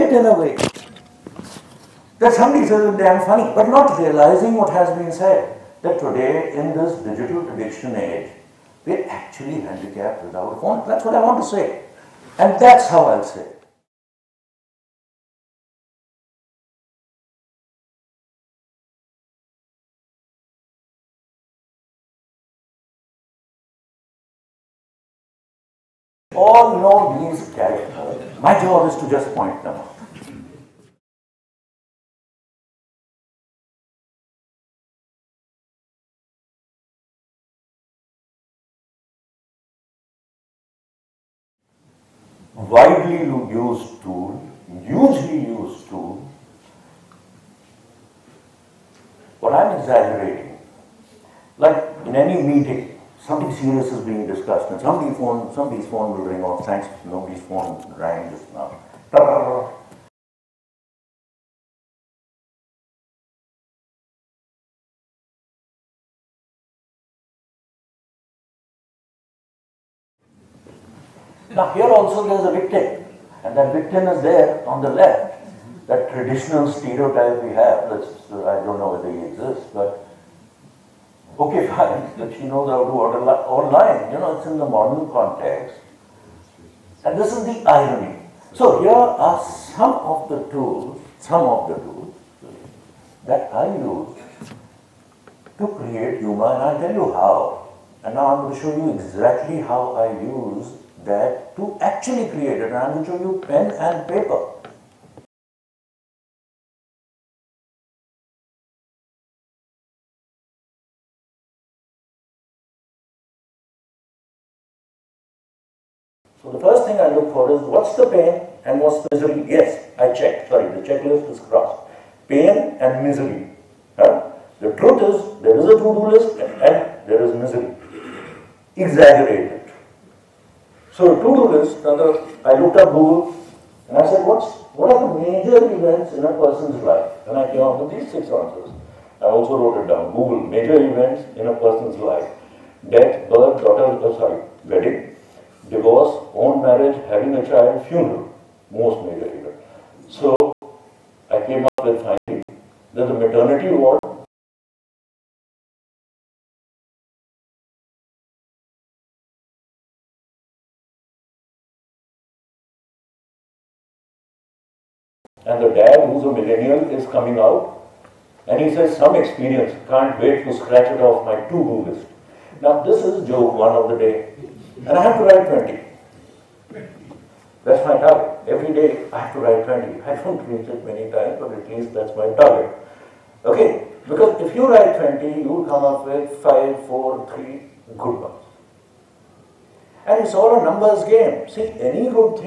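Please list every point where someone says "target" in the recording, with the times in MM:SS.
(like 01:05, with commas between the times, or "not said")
02:57, 03:02.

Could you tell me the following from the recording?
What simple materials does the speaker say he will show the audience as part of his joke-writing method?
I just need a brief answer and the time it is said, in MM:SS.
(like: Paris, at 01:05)
Pen and paper, at 01:43.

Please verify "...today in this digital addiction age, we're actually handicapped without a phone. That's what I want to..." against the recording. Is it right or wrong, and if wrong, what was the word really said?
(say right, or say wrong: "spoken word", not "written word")
right.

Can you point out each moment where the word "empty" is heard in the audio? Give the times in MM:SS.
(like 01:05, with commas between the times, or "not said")
not said.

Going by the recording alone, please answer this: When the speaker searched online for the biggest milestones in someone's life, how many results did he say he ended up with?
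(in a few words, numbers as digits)
6.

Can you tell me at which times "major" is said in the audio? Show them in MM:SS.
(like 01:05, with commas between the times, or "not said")
02:15, 02:20, 02:29.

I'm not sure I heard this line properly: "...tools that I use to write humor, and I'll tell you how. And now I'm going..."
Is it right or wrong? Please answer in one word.
wrong.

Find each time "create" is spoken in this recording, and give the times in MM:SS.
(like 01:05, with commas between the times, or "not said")
01:35, 01:42.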